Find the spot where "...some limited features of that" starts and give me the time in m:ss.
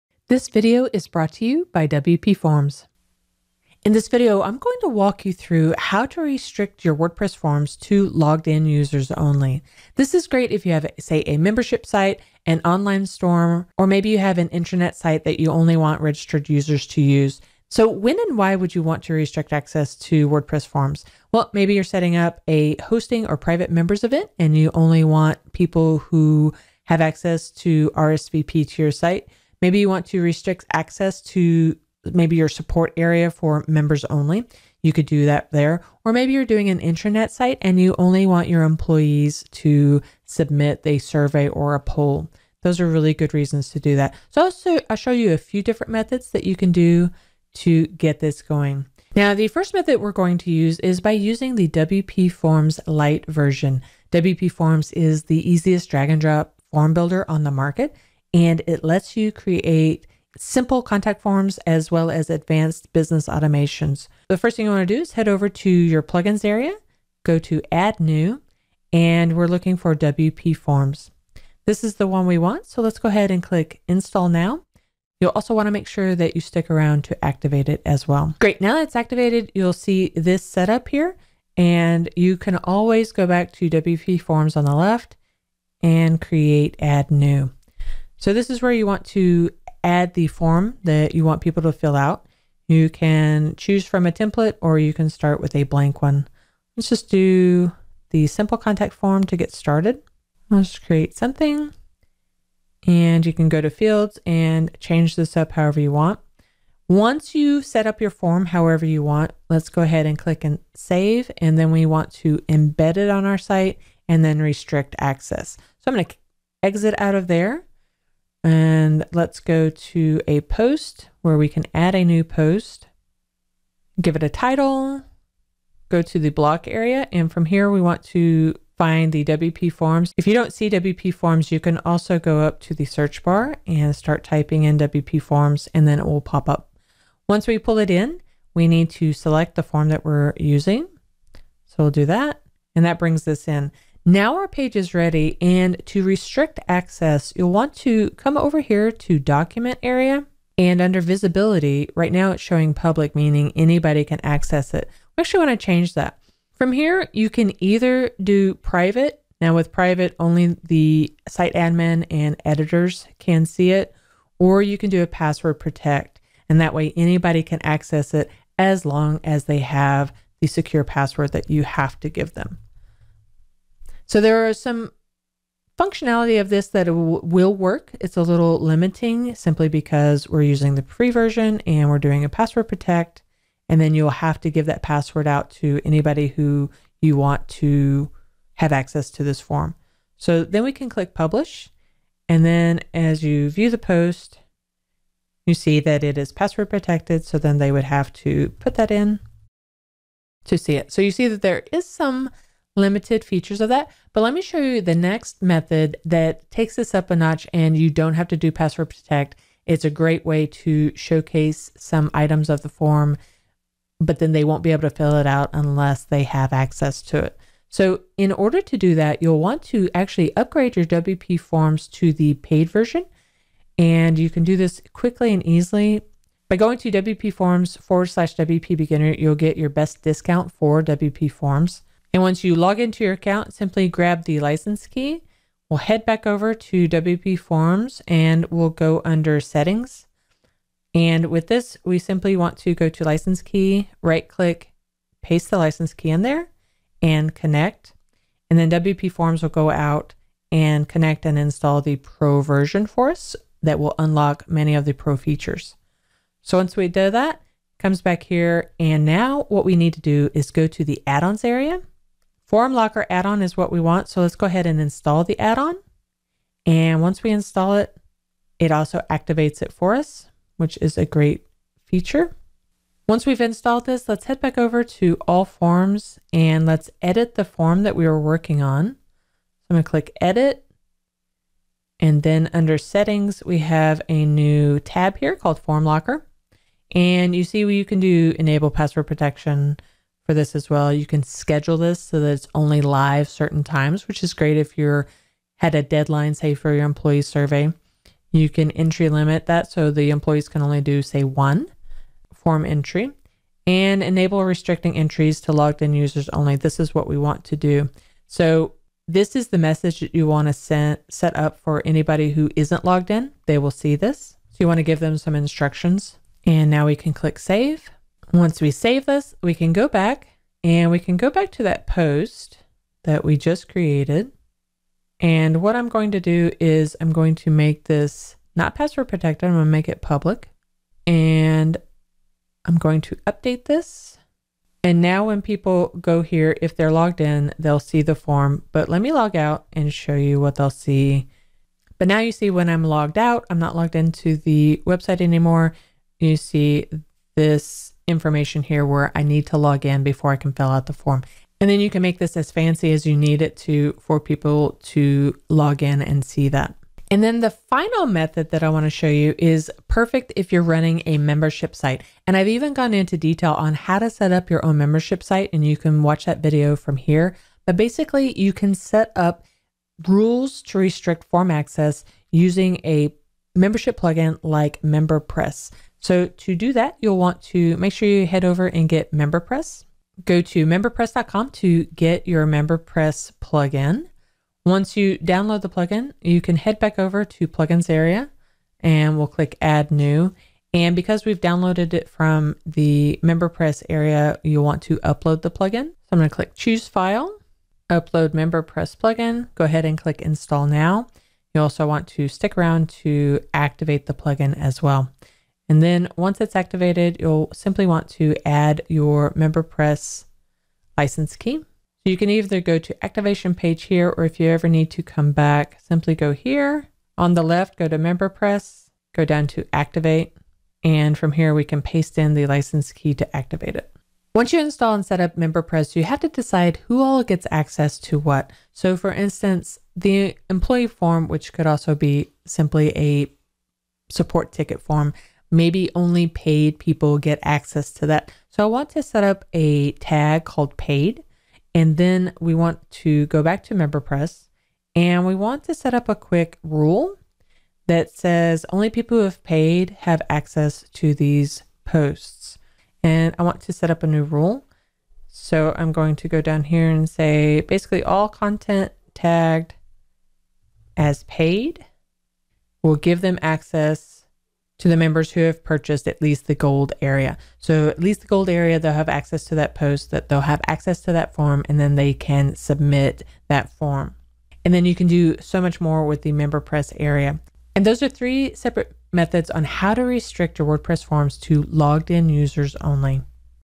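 3:21.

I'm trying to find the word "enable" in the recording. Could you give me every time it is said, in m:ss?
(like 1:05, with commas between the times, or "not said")
4:48, 5:04.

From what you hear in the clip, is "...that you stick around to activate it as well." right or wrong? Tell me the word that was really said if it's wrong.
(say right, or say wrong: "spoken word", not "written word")
right.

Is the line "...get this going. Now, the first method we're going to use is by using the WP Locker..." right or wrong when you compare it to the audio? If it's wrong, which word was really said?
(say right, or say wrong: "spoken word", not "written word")
wrong: "Forms", not "Locker".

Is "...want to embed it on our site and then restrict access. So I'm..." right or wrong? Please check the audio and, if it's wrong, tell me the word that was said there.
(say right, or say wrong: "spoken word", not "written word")
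right.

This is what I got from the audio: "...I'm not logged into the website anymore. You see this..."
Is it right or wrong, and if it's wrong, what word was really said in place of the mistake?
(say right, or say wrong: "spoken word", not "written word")
right.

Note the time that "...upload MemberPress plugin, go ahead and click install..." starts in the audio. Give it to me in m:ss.
6:37.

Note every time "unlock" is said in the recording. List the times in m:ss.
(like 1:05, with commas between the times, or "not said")
4:13.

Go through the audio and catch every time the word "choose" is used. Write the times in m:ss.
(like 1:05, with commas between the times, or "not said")
1:33, 6:36.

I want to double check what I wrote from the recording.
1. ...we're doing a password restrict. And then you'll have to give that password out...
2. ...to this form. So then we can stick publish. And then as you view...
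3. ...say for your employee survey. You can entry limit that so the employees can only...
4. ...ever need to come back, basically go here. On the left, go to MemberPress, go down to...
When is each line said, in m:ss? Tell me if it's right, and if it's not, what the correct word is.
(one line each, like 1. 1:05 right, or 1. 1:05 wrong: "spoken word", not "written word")
1. 3:01 wrong: "protect", not "restrict"
2. 3:09 wrong: "click", not "stick"
3. 4:56 right
4. 6:54 wrong: "simply", not "basically".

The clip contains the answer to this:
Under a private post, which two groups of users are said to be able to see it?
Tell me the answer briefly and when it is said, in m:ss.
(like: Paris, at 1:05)
Admin and editors, at 2:41.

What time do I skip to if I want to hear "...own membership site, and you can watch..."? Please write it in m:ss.
6:04.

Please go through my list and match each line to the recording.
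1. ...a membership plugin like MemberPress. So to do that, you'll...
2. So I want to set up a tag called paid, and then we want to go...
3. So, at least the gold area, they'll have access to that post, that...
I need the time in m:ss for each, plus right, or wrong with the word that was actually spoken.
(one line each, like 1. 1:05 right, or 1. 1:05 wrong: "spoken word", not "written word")
1. 6:12 right
2. 7:18 right
3. 7:47 right.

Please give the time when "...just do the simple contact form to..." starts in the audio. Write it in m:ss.
1:36.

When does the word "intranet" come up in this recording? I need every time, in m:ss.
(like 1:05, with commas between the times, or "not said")
0:14, 0:36.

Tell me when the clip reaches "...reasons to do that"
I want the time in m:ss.
0:43.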